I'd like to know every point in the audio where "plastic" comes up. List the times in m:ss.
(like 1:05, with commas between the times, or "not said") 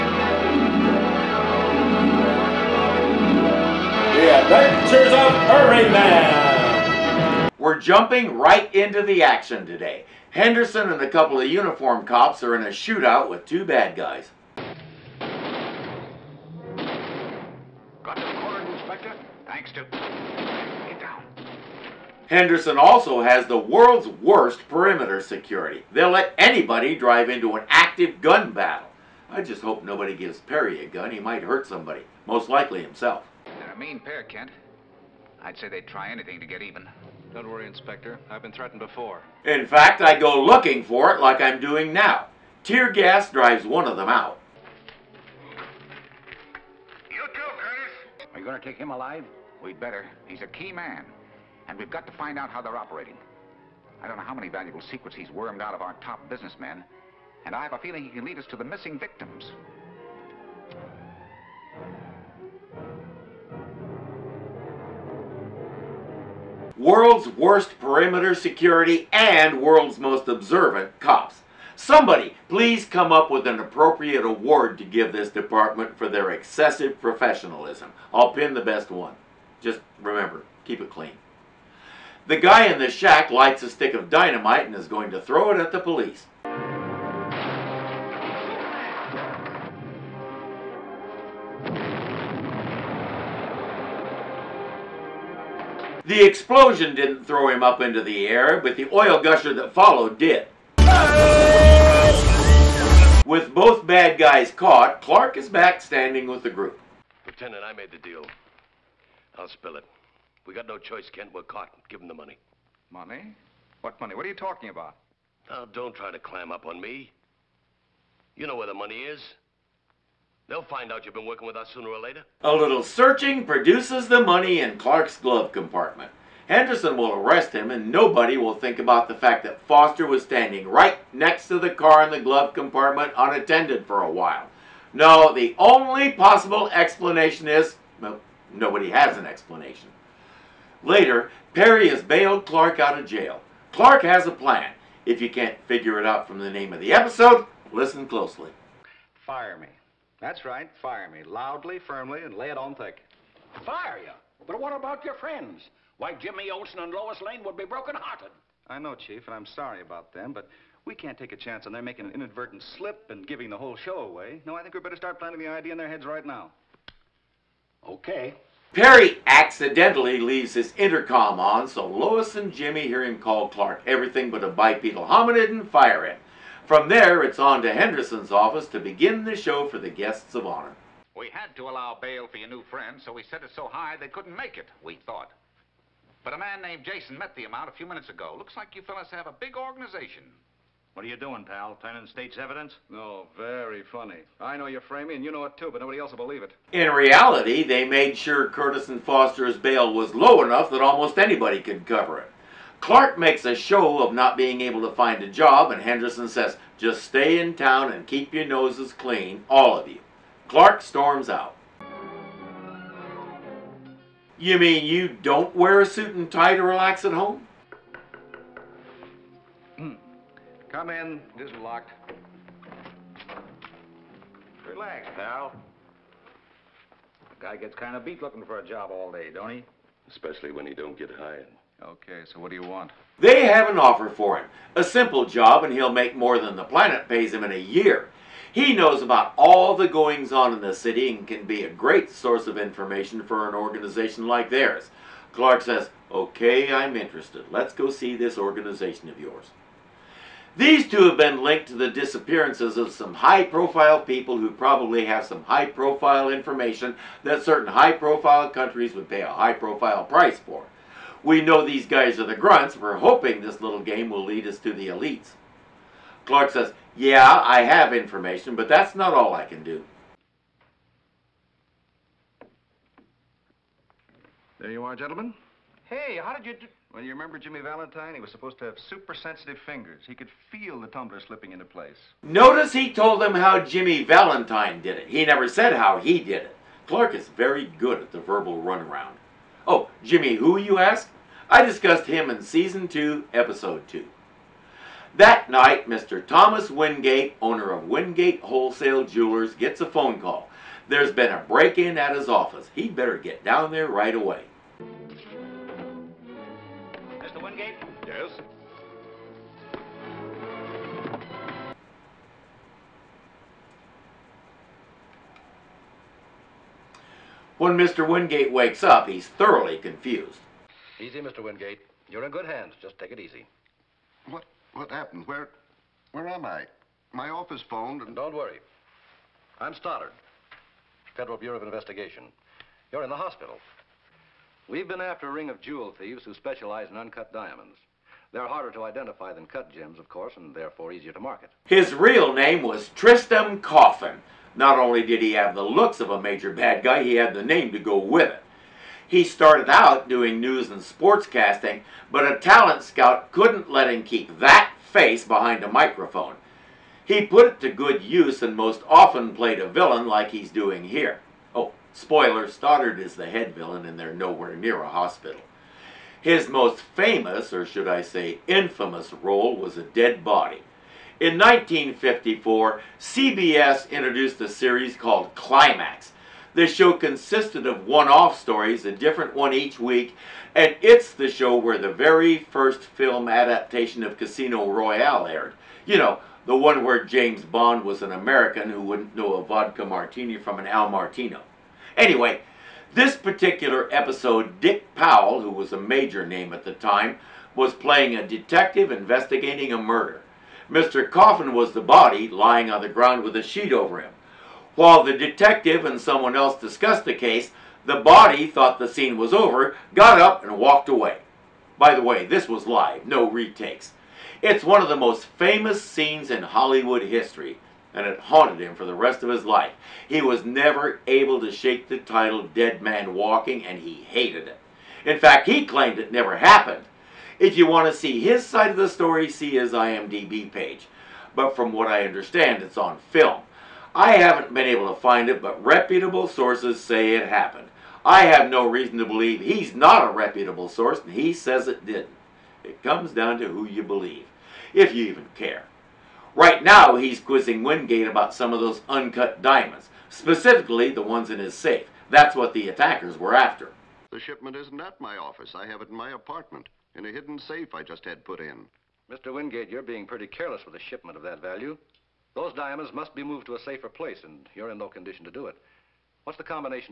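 not said.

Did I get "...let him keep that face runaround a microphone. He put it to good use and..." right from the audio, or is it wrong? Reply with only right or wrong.
wrong.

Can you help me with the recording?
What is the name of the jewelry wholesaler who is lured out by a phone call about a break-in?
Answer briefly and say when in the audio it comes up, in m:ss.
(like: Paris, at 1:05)
Thomas Wingate, at 4:56.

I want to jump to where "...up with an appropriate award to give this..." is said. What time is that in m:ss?
1:13.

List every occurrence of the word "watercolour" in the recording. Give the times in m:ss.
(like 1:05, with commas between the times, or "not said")
not said.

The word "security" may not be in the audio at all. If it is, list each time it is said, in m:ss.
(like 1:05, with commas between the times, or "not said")
0:25, 1:08.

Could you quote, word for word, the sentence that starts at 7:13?
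I haven't been able to find it, but reputable sources say it happened.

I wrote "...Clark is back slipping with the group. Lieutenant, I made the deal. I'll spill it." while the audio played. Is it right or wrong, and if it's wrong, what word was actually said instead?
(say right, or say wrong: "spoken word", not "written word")
wrong: "standing", not "slipping".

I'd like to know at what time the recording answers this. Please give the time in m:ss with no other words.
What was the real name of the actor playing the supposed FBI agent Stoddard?
5:42.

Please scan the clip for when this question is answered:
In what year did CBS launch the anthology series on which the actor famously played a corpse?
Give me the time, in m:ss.
6:11.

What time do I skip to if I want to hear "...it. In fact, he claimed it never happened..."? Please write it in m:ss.
7:04.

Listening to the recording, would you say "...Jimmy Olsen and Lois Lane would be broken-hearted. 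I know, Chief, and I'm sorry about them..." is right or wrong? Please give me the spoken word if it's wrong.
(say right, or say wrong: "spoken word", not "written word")
right.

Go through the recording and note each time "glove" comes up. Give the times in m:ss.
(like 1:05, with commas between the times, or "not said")
2:05, 2:12.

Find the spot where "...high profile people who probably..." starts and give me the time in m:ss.
4:13.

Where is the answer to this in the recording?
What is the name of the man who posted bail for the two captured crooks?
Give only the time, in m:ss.
3:06.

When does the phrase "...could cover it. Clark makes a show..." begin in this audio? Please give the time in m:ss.
3:21.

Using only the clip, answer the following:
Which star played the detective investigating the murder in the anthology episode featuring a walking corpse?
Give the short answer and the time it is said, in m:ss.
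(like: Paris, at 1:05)
Dick Powell, at 6:34.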